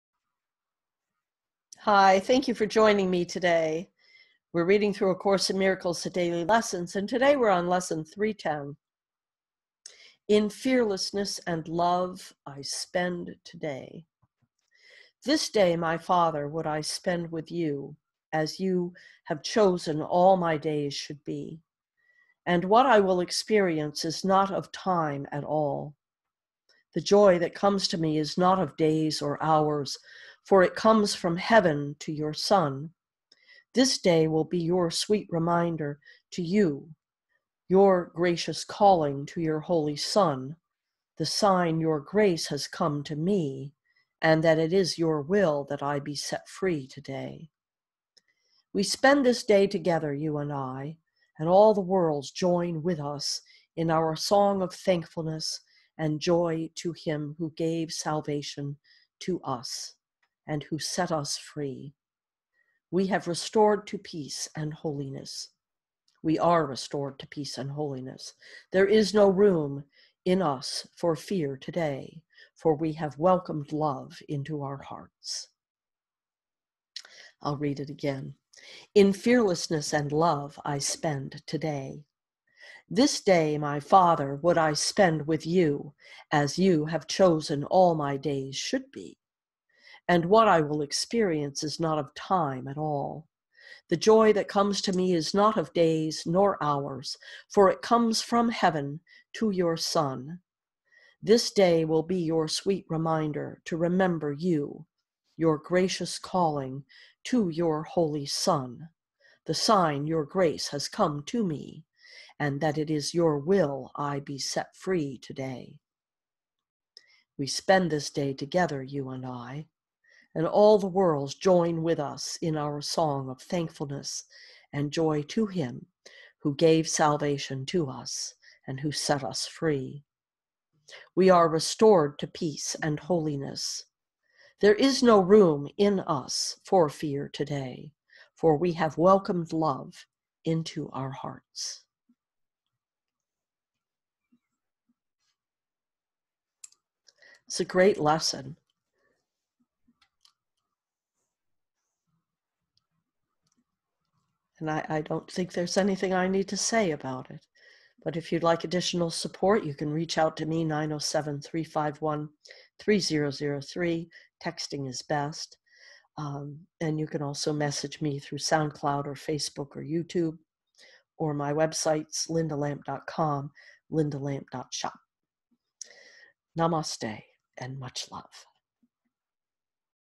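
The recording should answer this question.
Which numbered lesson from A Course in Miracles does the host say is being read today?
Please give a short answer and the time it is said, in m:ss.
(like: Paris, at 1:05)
310, at 0:07.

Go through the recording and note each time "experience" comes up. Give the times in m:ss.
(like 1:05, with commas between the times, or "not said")
0:23, 1:30.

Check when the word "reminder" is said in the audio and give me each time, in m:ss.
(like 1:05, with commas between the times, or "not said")
0:35, 1:42.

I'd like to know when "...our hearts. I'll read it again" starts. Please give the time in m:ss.
1:14.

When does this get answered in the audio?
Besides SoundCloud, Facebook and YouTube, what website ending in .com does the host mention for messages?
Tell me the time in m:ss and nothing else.
2:52.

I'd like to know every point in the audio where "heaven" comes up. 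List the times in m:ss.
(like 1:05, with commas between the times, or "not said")
0:31, 1:38.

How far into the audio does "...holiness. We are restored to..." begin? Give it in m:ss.
1:04.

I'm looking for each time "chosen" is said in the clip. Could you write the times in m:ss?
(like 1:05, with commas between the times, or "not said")
0:19, 1:27.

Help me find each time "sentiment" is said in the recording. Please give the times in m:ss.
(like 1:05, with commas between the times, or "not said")
not said.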